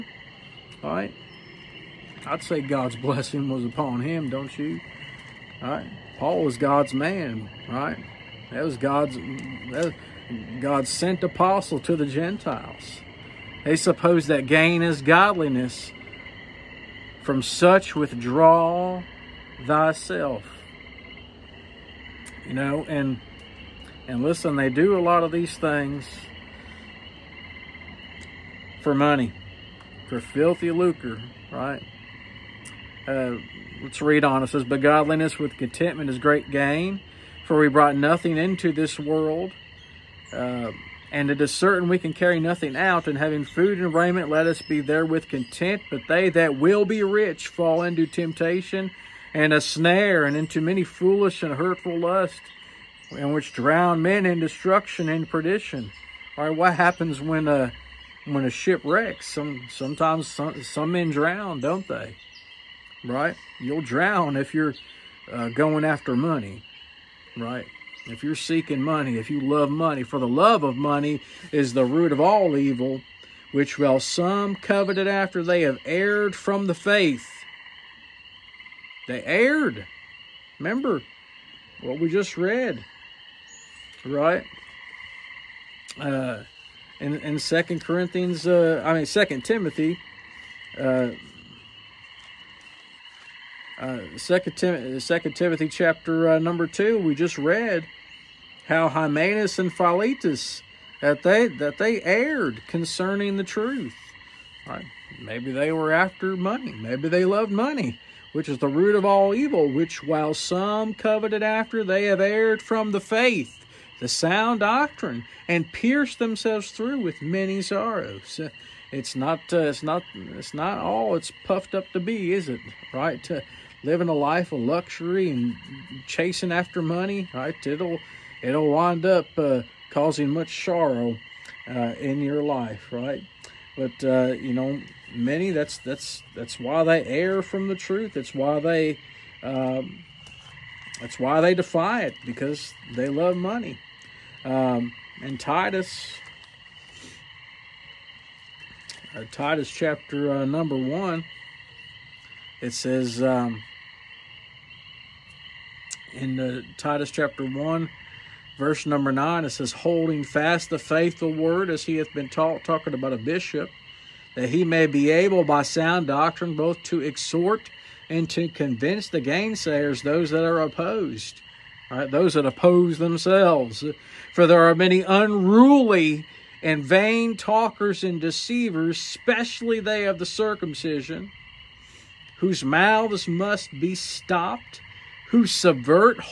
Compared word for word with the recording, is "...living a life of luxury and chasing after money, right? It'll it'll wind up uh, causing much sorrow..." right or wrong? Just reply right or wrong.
right.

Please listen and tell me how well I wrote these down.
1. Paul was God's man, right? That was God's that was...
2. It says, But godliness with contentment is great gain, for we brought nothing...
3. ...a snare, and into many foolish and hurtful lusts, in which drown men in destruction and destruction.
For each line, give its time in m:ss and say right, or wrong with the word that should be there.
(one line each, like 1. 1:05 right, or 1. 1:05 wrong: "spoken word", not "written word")
1. 0:06 right
2. 0:34 right
3. 0:49 wrong: "perdition", not "destruction".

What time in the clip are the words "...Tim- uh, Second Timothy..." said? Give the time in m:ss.
1:34.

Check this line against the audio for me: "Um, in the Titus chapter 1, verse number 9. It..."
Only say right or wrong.
right.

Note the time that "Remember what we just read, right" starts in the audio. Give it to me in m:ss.
1:20.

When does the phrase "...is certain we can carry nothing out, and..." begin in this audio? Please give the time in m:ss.
0:41.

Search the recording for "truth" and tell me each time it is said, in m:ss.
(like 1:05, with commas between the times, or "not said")
1:43, 2:17.